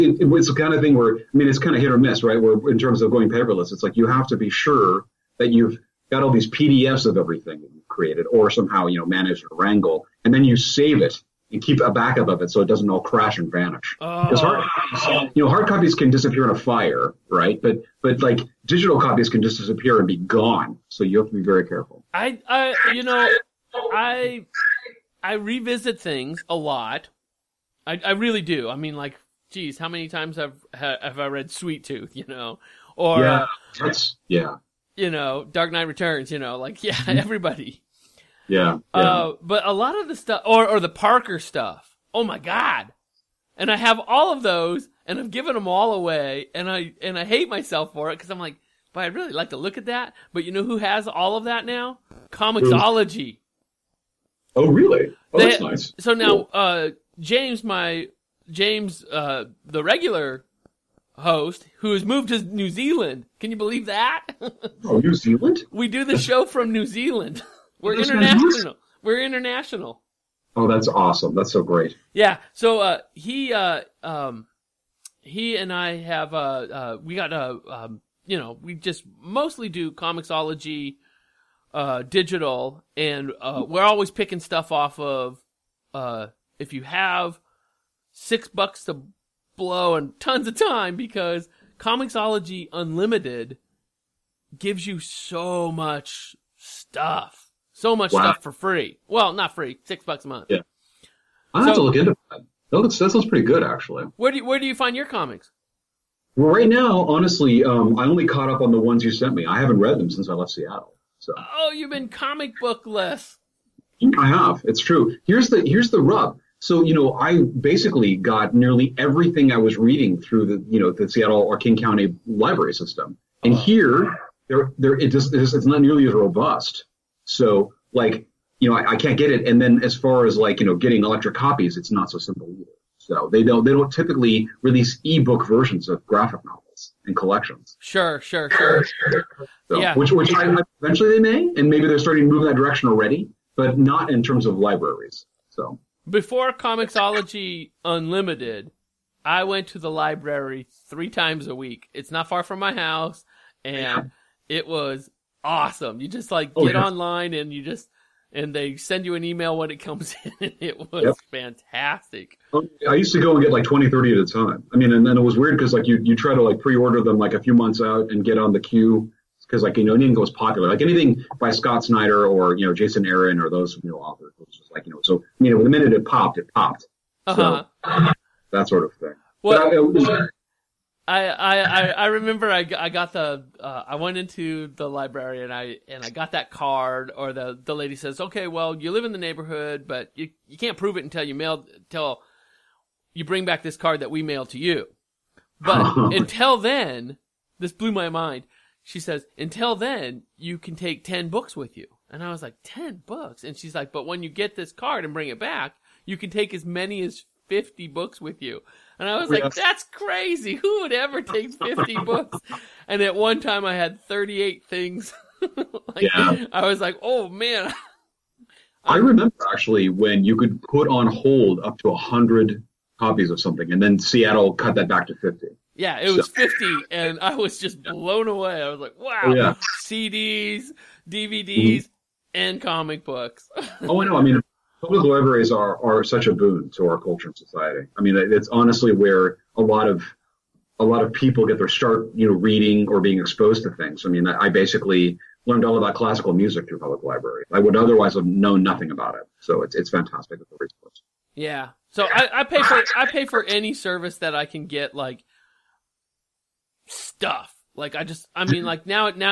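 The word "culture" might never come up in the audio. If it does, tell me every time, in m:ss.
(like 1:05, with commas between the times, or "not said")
3:57.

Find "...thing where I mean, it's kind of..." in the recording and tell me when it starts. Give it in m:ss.
0:00.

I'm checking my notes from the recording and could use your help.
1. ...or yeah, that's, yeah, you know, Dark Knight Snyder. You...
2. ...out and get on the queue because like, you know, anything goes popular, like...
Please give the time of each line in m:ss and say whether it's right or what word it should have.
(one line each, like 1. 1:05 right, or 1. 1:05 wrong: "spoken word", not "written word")
1. 0:32 wrong: "Returns", not "Snyder"
2. 2:47 right.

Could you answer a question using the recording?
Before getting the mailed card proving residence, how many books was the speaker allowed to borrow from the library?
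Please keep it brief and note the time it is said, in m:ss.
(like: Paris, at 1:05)
10, at 3:21.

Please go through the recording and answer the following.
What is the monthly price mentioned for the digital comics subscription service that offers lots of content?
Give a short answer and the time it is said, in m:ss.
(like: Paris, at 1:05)
$6, at 1:39.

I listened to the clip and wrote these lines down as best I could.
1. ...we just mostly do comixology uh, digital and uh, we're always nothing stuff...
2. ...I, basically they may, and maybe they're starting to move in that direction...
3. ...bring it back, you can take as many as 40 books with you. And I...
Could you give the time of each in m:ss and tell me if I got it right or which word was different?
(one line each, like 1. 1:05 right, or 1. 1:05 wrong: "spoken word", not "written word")
1. 1:18 wrong: "picking", not "nothing"
2. 2:20 wrong: "eventually", not "basically"
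3. 3:25 wrong: "50", not "40".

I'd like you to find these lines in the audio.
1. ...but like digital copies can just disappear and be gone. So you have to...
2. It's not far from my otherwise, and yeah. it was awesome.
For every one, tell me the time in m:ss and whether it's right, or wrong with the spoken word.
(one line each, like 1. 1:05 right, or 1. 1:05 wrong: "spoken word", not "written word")
1. 0:18 right
2. 2:31 wrong: "house", not "otherwise".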